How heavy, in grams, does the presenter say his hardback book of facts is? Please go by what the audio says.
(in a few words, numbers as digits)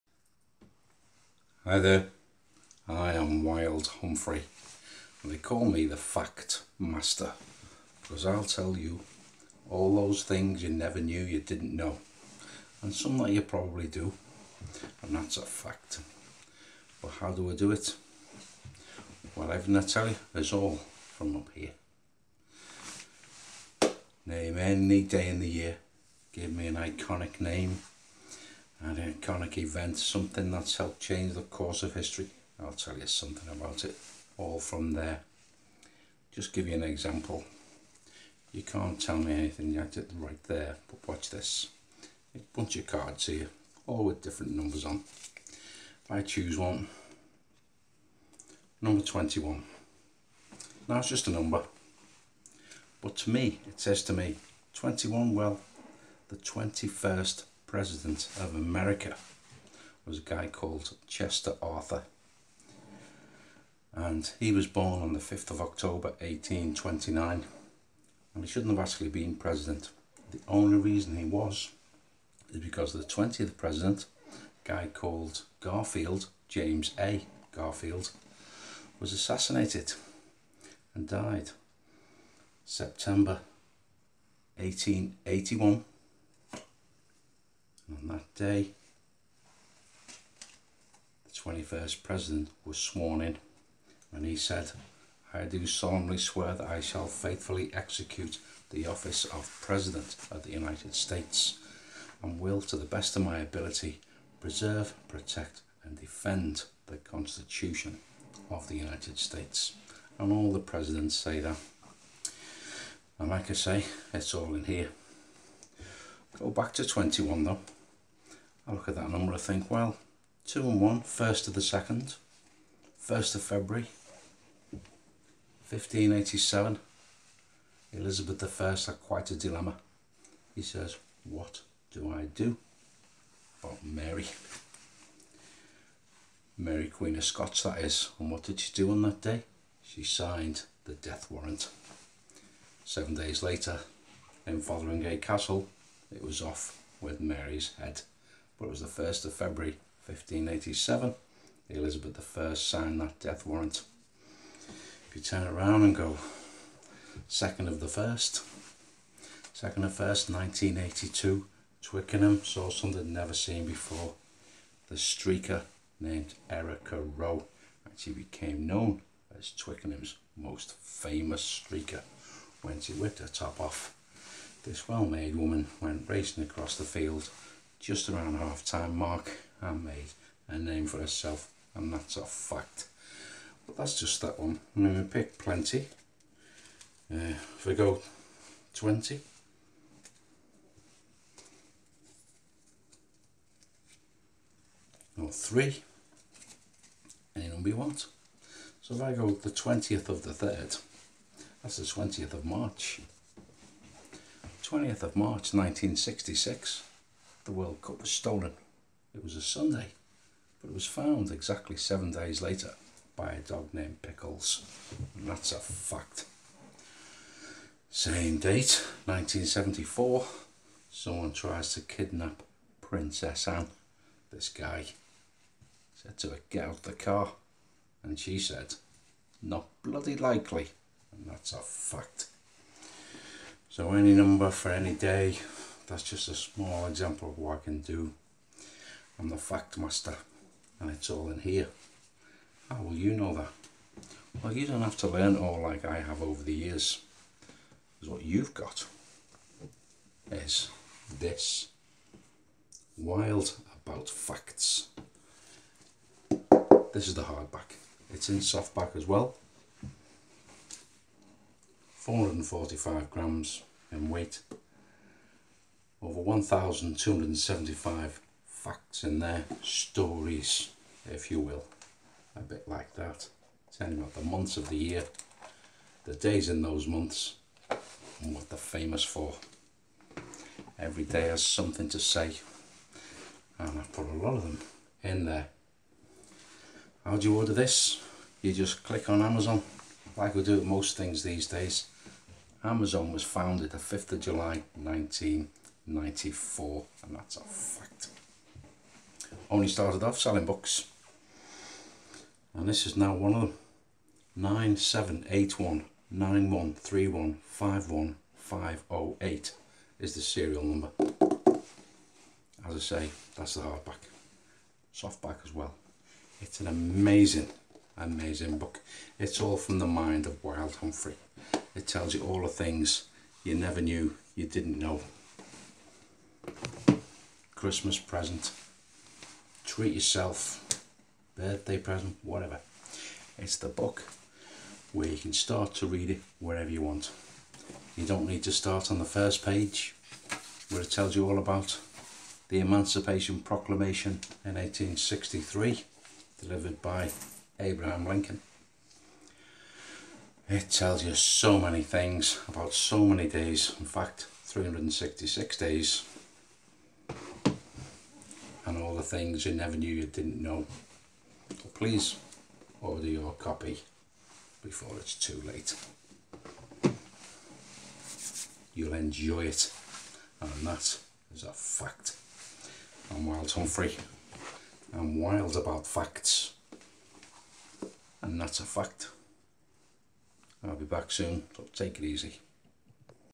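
445 grams.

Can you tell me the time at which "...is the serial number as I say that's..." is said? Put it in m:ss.
5:09.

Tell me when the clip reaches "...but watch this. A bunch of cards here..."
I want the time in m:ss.
0:40.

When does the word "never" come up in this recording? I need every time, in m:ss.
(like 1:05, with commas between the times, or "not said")
0:10, 2:43, 5:23, 5:59.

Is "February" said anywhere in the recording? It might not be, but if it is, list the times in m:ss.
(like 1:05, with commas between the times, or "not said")
2:03, 2:29.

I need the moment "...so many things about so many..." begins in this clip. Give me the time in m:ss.
5:51.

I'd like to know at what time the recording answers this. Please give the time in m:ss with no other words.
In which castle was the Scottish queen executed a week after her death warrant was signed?
2:24.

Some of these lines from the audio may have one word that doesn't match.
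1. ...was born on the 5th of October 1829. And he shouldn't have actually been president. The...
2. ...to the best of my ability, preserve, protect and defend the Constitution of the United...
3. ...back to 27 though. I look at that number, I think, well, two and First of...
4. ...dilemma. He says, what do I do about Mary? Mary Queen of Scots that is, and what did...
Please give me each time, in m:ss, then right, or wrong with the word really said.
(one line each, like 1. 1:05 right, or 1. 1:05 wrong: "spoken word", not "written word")
1. 1:04 right
2. 1:42 right
3. 1:56 wrong: "21", not "27"
4. 2:09 right.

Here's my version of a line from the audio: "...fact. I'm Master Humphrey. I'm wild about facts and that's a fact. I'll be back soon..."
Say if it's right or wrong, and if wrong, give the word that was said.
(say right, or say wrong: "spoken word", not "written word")
wrong: "Wild", not "Master".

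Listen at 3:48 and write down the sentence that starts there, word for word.
And she said, not bloody likely.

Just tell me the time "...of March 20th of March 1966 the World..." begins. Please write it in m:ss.
3:22.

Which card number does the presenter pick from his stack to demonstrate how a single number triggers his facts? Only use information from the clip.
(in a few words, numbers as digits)
21.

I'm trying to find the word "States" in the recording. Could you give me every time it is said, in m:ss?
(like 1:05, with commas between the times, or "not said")
1:40, 1:49.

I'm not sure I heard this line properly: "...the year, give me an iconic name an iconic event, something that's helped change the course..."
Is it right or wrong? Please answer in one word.
right.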